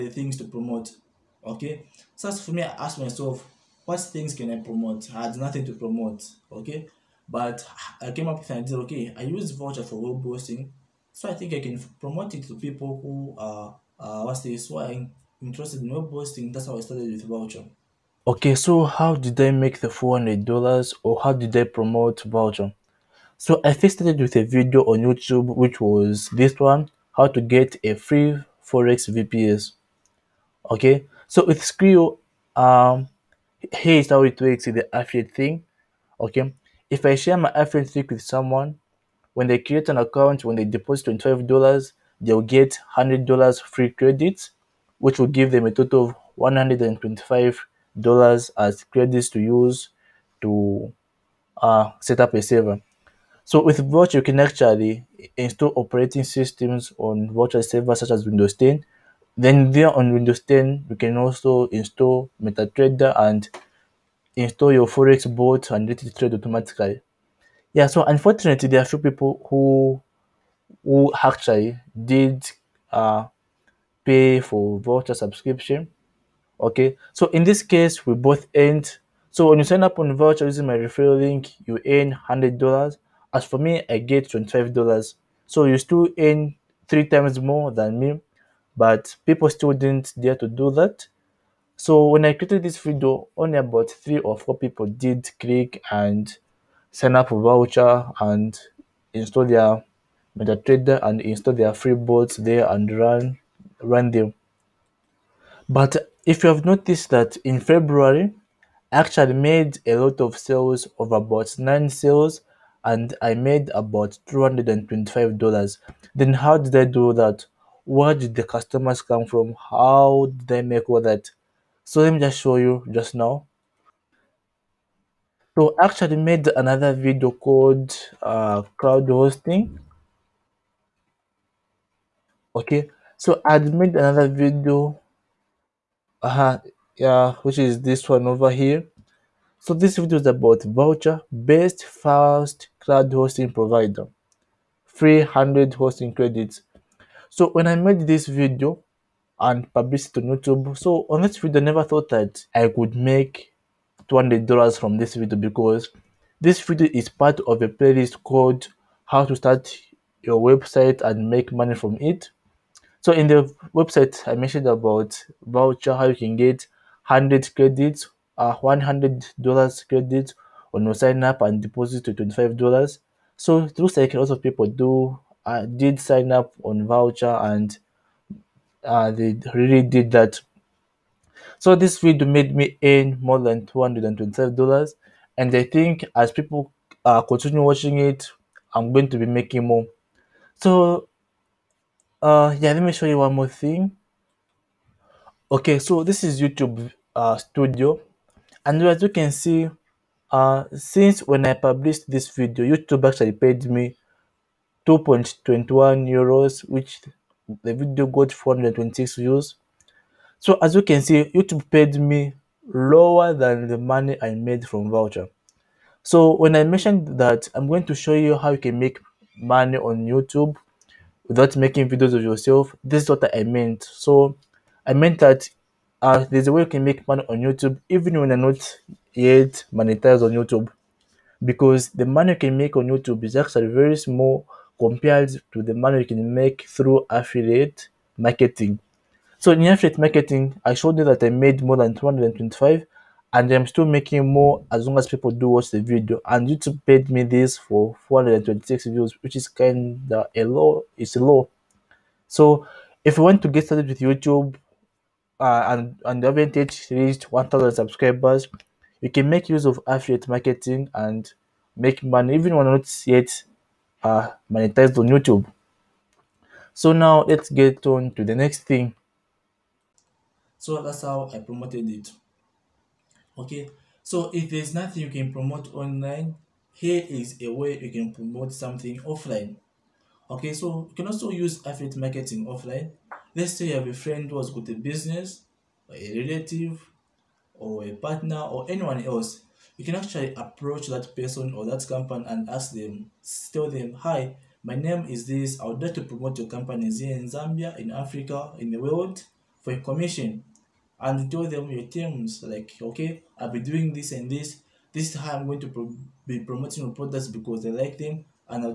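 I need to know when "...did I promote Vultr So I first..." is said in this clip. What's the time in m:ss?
0:21.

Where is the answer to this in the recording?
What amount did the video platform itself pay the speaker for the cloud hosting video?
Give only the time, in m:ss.
3:24.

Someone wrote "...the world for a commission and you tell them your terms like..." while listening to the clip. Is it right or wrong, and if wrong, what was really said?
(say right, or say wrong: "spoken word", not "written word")
right.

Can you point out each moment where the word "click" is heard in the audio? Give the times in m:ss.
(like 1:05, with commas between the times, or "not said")
1:35.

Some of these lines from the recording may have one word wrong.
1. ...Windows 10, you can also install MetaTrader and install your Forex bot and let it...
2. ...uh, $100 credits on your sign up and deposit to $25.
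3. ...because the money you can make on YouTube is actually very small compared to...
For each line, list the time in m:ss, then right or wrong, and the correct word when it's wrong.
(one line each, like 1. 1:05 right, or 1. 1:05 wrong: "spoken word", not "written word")
1. 1:00 right
2. 2:48 right
3. 3:51 right.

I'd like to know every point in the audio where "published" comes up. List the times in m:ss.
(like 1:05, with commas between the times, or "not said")
2:29, 3:21.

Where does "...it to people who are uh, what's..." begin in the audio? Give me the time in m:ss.
0:12.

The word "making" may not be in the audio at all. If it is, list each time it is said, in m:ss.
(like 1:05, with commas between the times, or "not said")
3:09, 3:41, 4:03.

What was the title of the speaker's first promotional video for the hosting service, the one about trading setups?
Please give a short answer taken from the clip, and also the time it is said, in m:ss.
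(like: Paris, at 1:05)
How to get a free Forex VPS, at 0:27.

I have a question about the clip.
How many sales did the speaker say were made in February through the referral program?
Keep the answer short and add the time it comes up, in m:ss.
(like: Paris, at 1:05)
9, at 1:51.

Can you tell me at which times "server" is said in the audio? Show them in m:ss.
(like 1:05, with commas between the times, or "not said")
0:52, 0:57.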